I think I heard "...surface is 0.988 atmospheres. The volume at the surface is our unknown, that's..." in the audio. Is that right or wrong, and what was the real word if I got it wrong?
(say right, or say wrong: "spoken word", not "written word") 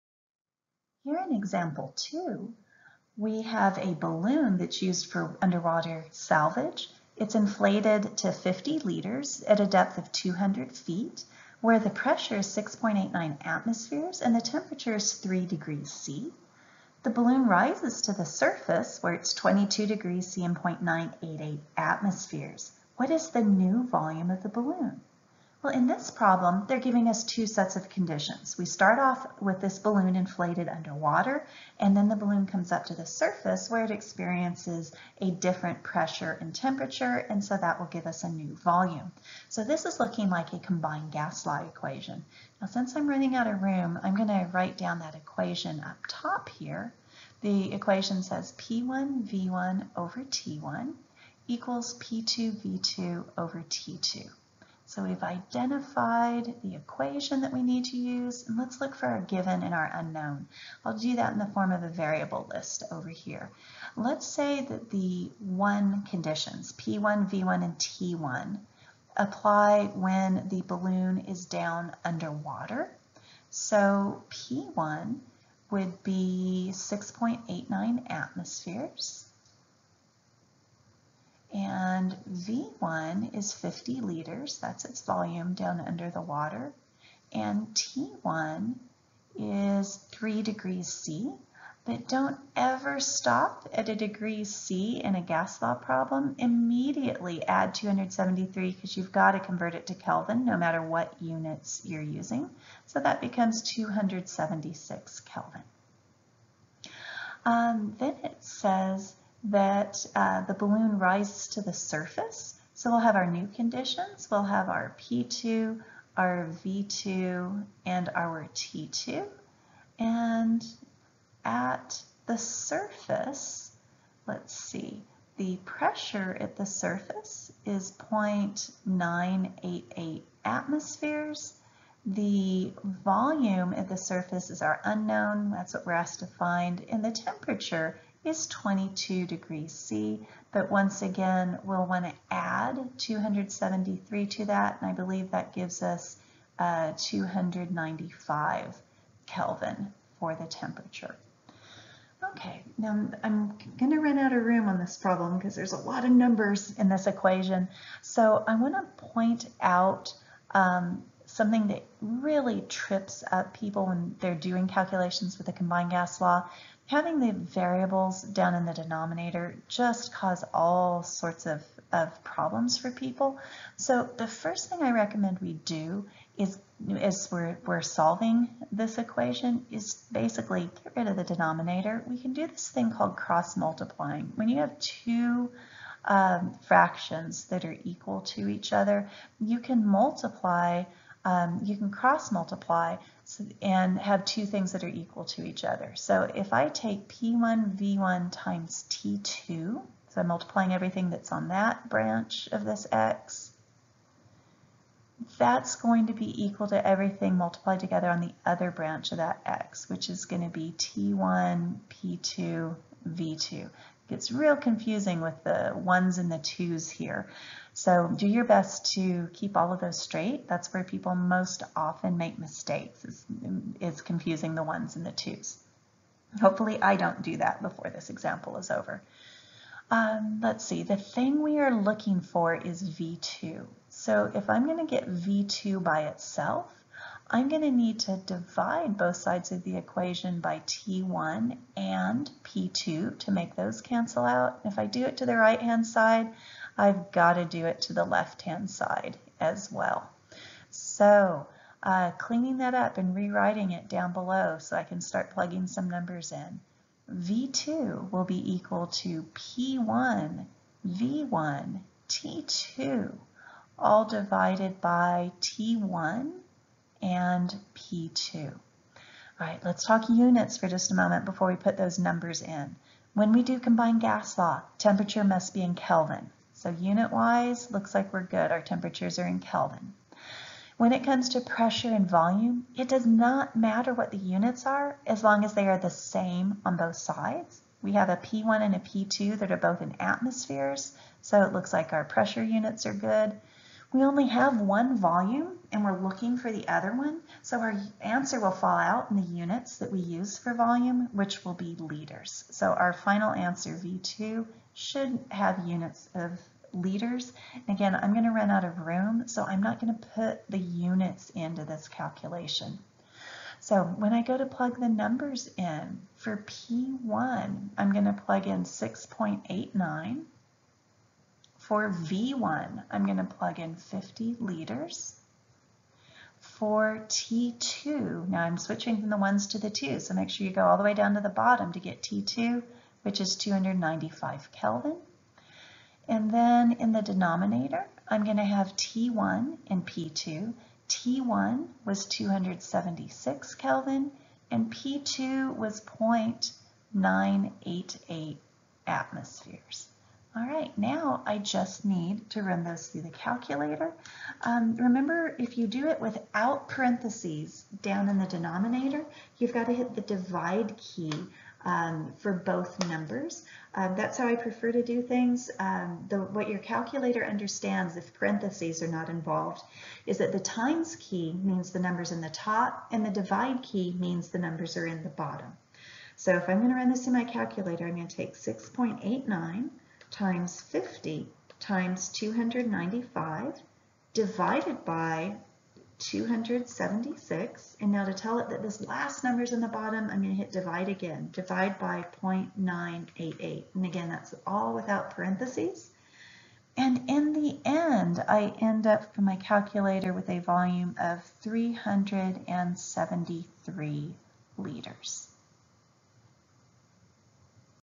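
right.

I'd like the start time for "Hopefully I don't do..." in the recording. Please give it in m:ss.
3:46.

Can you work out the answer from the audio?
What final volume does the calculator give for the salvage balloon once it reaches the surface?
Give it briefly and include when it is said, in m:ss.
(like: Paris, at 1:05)
373 liters, at 6:41.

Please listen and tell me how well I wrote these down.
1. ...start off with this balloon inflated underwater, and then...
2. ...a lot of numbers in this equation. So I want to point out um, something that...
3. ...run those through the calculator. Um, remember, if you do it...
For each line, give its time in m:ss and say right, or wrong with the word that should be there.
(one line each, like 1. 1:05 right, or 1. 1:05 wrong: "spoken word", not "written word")
1. 0:28 right
2. 2:35 right
3. 5:52 right.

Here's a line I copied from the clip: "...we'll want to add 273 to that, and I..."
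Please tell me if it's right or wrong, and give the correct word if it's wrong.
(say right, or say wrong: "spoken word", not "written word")
right.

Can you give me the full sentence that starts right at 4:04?
If I do it to the right-hand side, I've got to do it to the left-hand side as well.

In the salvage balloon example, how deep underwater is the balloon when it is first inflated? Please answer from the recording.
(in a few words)
200 feet.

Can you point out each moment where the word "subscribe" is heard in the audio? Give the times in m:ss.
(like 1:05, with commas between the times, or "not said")
not said.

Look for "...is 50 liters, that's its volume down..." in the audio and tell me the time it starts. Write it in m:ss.
1:23.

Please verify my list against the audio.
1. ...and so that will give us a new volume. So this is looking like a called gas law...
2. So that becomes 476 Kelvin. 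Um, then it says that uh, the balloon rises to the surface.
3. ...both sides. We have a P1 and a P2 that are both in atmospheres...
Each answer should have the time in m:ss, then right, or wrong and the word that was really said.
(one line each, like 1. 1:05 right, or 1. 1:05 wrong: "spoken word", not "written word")
1. 0:37 wrong: "combined", not "called"
2. 1:42 wrong: "276", not "476"
3. 4:46 right.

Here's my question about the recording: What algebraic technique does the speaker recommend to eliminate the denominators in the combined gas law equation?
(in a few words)
cross multiplying.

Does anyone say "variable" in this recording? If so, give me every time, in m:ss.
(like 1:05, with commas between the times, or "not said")
1:01, 2:47.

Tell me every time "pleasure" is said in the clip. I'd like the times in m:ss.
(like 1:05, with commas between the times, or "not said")
not said.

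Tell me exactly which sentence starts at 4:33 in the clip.
When we do combined gas law, temperature must be in Kelvin.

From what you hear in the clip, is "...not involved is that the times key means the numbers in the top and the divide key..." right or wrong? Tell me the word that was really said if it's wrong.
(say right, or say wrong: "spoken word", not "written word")
right.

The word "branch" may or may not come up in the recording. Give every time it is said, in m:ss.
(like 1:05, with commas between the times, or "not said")
3:21, 3:28.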